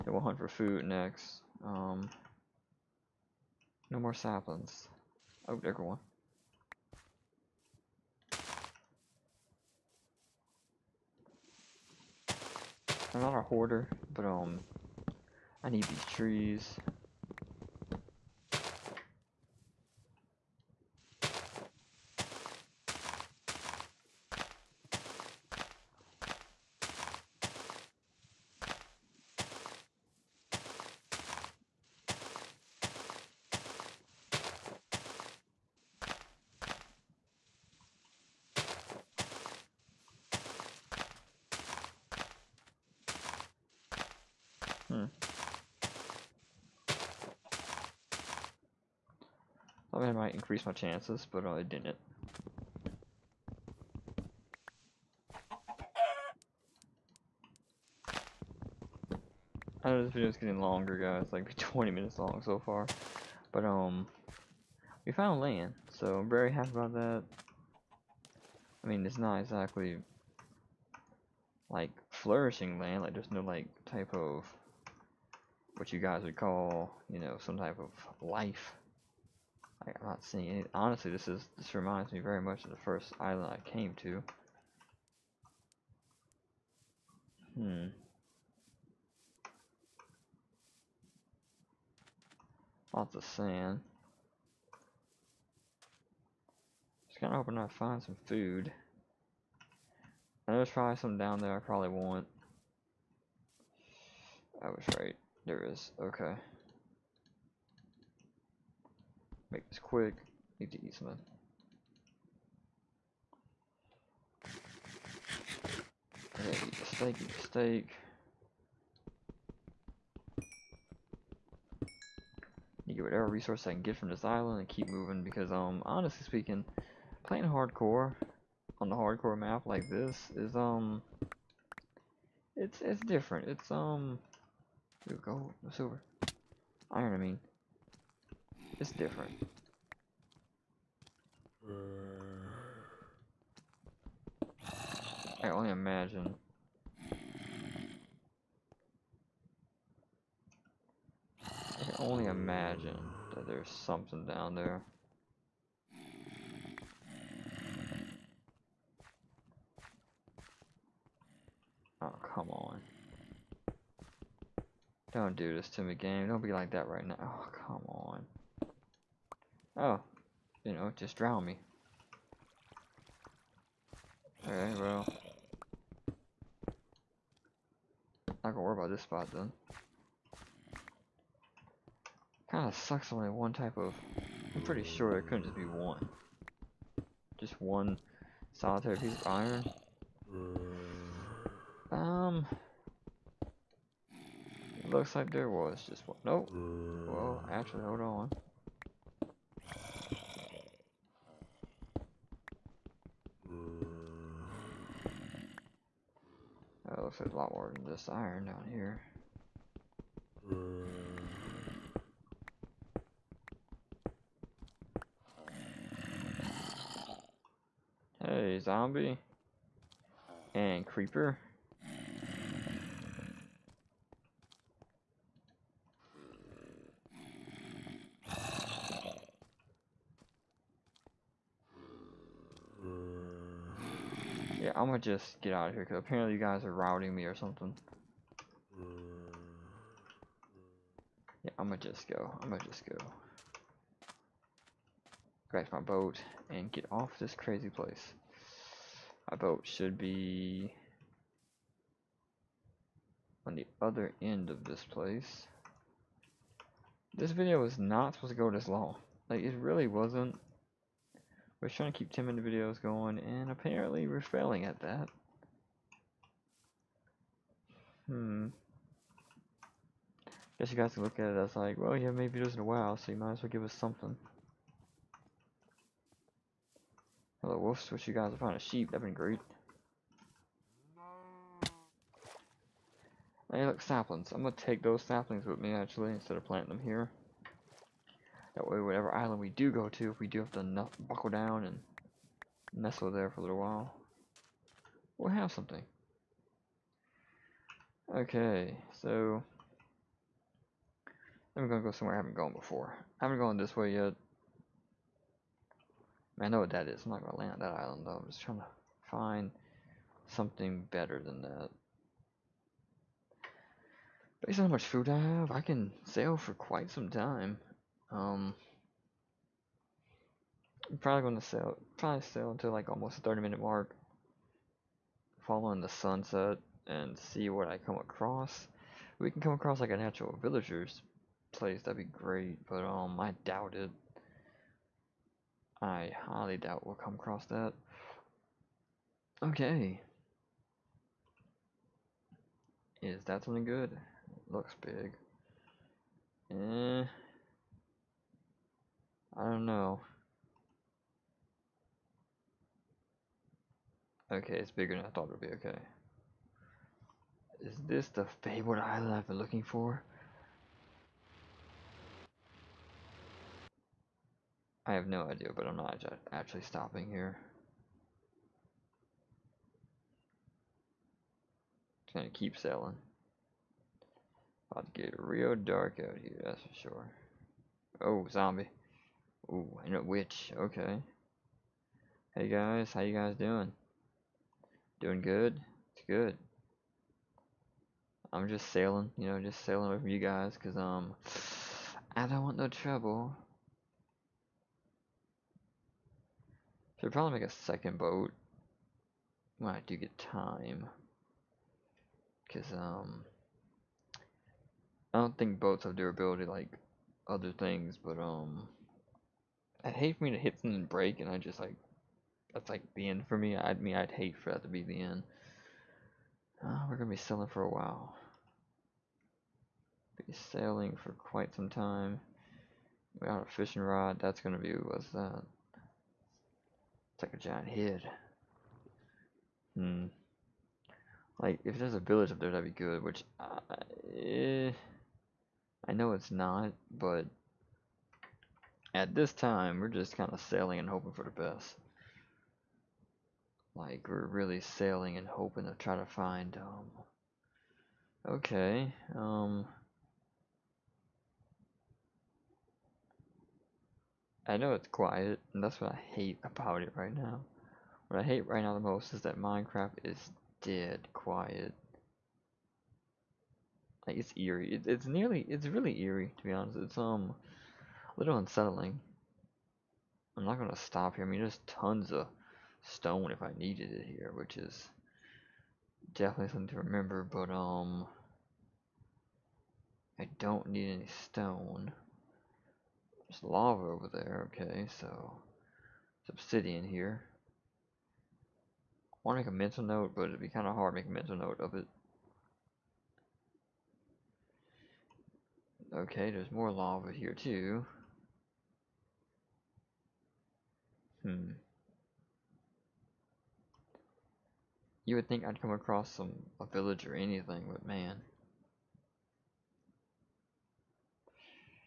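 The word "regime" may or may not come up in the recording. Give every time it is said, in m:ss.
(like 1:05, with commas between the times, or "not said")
not said.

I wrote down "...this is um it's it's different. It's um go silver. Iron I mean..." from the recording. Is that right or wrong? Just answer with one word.
right.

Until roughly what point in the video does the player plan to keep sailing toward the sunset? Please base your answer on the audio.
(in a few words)
30 minute mark.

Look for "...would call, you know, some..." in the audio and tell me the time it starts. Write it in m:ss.
1:16.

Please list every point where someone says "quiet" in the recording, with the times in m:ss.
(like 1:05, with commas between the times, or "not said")
7:34, 7:41.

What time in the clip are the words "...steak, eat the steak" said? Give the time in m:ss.
1:56.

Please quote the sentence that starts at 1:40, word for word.
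I know there's probably some down there I probably want.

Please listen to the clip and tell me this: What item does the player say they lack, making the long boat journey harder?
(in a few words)
fishing rod.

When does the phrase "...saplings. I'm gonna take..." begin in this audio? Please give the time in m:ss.
4:43.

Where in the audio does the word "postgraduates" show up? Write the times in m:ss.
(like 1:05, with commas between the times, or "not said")
not said.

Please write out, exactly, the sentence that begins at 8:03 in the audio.
There's lava over there, okay, so it's obsidian here.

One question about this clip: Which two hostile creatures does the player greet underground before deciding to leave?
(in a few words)
zombie and creeper.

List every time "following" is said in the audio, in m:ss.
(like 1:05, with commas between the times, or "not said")
5:25.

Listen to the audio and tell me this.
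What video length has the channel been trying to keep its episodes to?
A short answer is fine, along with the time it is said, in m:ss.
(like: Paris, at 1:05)
10 minutes, at 4:22.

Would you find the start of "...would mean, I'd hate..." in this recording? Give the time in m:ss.
6:53.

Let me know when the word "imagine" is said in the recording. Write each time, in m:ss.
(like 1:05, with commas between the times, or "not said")
2:25, 2:32.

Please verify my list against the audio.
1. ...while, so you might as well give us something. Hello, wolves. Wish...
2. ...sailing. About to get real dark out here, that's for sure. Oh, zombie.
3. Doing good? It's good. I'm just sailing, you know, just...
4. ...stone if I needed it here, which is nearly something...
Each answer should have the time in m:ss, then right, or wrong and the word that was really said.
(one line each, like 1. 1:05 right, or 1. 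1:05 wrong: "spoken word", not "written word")
1. 4:32 right
2. 6:12 right
3. 6:24 right
4. 7:52 wrong: "definitely", not "nearly".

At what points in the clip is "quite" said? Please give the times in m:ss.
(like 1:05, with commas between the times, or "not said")
5:16, 7:01.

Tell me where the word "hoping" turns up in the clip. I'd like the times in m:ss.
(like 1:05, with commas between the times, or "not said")
1:37, 7:20, 7:25.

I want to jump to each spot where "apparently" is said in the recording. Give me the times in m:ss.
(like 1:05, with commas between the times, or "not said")
3:55, 4:23.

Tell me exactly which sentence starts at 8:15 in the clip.
Okay, there's more lava here too.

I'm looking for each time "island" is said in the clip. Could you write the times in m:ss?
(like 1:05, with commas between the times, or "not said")
1:23, 2:04, 4:49, 5:07, 5:58.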